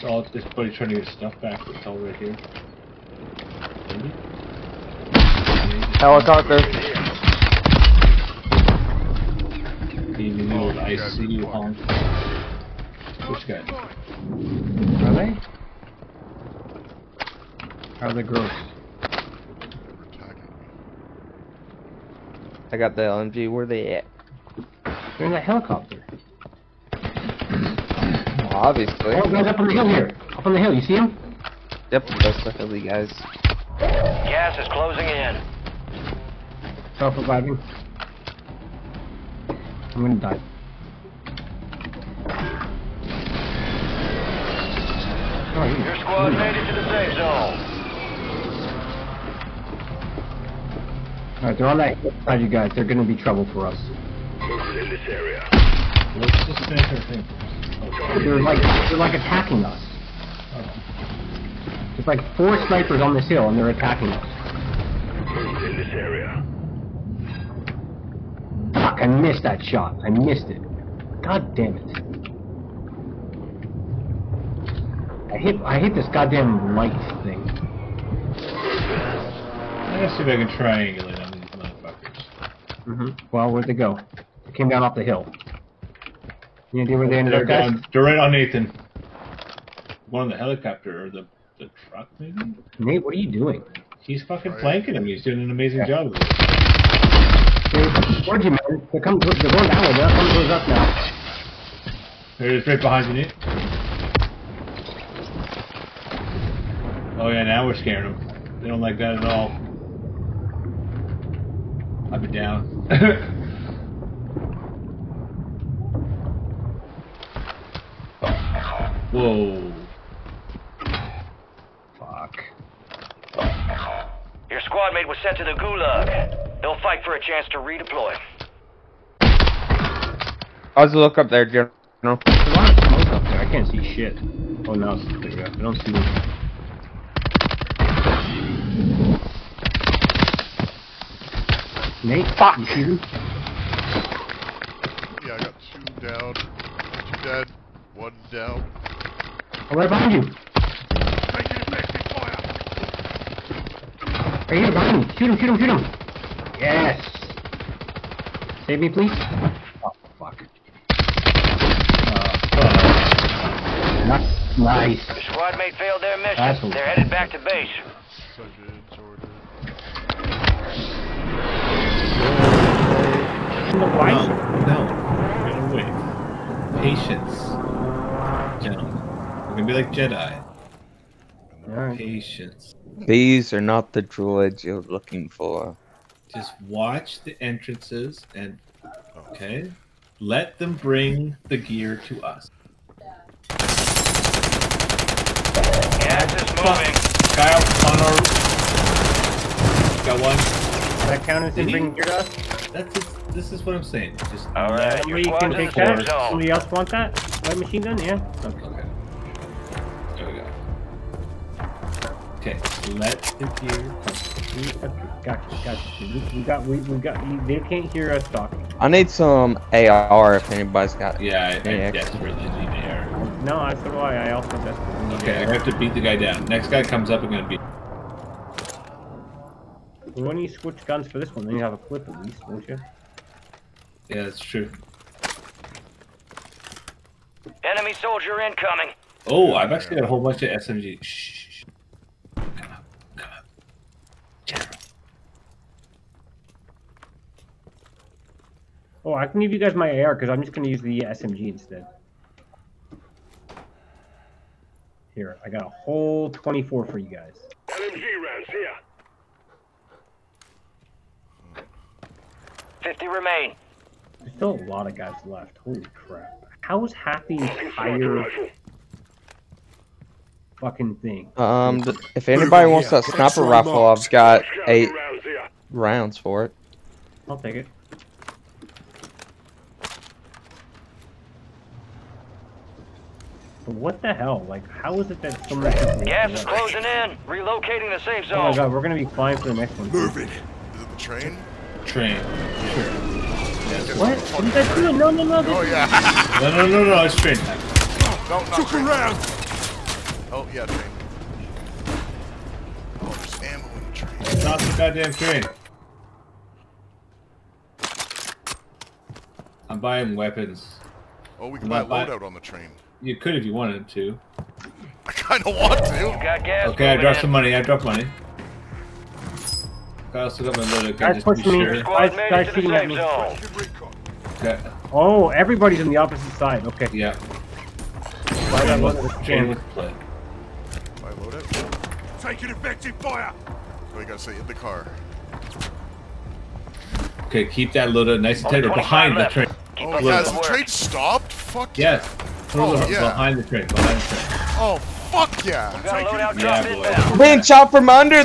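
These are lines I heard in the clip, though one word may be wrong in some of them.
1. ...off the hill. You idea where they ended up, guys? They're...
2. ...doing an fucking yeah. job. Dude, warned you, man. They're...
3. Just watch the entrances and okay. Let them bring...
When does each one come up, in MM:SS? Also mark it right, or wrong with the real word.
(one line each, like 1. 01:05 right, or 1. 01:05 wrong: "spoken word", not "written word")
1. 01:24 right
2. 01:35 wrong: "amazing", not "fucking"
3. 03:06 right.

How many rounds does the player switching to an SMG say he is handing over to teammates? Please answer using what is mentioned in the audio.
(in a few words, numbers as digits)
24.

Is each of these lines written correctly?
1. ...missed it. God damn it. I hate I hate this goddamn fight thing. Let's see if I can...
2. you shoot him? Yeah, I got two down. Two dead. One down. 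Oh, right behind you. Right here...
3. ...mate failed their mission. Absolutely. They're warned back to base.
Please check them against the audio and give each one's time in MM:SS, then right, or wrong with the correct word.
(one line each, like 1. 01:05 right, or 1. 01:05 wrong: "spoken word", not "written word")
1. 01:10 wrong: "light", not "fight"
2. 02:22 right
3. 02:45 wrong: "headed", not "warned".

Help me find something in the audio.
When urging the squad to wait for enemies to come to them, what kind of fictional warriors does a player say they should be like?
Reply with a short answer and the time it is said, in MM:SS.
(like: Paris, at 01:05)
Jedi, at 02:59.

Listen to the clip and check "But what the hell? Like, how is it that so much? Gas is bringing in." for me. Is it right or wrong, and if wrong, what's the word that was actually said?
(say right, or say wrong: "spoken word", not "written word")
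wrong: "closing", not "bringing".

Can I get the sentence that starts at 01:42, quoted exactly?
There it is, right behind you, Nate.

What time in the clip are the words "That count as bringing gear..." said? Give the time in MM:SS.
03:21.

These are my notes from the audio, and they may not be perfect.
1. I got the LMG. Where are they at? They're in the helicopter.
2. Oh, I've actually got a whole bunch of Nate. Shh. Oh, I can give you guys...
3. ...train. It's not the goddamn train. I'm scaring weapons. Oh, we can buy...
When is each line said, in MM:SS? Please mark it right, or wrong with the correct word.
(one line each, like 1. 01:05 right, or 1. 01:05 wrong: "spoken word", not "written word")
1. 00:22 right
2. 03:59 wrong: "SMG", not "Nate"
3. 05:03 wrong: "buying", not "scaring".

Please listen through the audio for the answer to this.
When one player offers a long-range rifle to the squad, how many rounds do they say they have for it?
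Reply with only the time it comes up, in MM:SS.
04:34.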